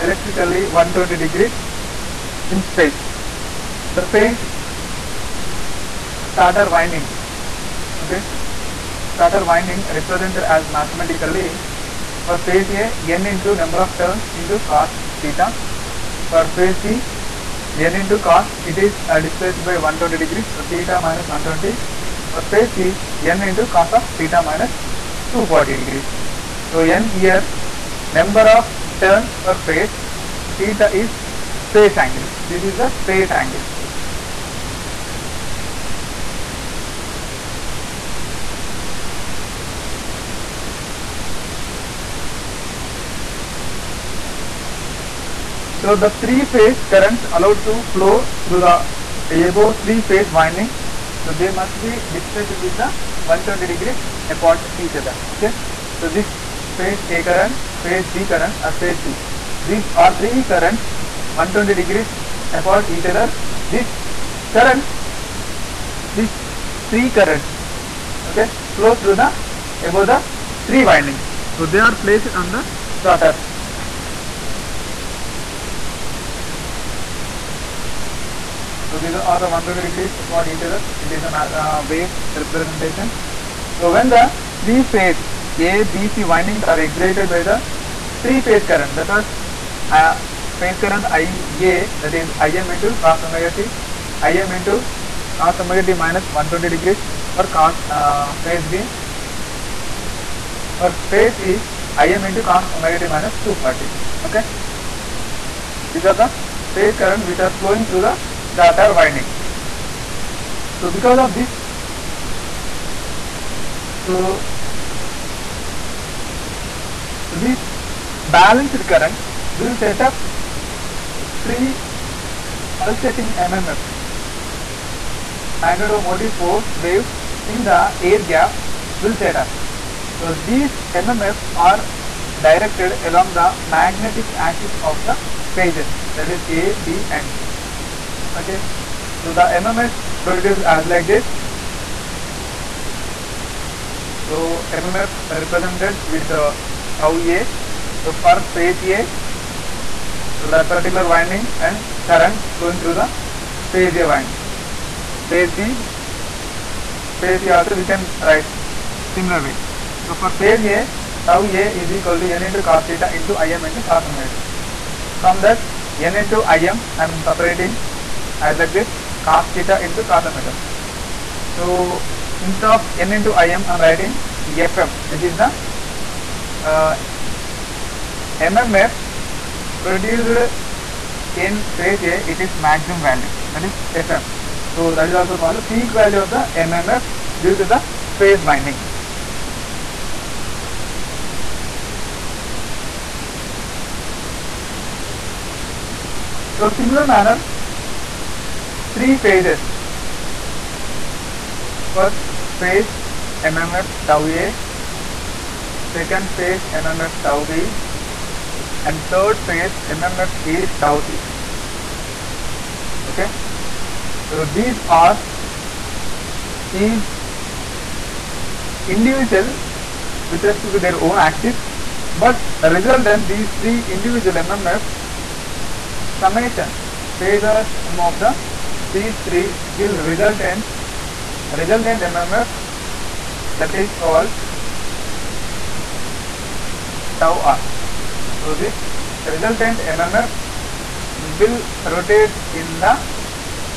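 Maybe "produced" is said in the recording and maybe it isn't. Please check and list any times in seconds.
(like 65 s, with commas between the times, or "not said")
140 s, 179 s.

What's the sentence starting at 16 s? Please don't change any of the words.
For phase B n into cos it is uh, displaced by 120 degrees so theta minus 120.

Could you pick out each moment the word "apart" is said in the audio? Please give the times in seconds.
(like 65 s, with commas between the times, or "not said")
54 s, 62 s, 80 s.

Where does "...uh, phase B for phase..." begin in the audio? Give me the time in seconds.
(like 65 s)
97 s.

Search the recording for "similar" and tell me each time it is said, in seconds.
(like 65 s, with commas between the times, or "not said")
159 s, 196 s.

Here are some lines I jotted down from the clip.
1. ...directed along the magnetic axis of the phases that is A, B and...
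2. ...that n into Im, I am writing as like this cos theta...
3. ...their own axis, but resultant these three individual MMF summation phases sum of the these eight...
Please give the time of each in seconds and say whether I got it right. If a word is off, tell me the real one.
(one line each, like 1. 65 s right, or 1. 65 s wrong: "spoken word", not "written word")
1. 132 s right
2. 165 s wrong: "separating", not "writing"
3. 220 s wrong: "three", not "eight".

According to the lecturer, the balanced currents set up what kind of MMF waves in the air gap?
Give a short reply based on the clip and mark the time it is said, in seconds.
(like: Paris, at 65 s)
pulsating, at 122 s.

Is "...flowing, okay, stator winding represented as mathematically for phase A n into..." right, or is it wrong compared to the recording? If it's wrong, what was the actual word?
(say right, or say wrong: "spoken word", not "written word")
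wrong: "winding", not "flowing".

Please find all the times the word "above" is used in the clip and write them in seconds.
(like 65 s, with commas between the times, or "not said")
49 s, 69 s.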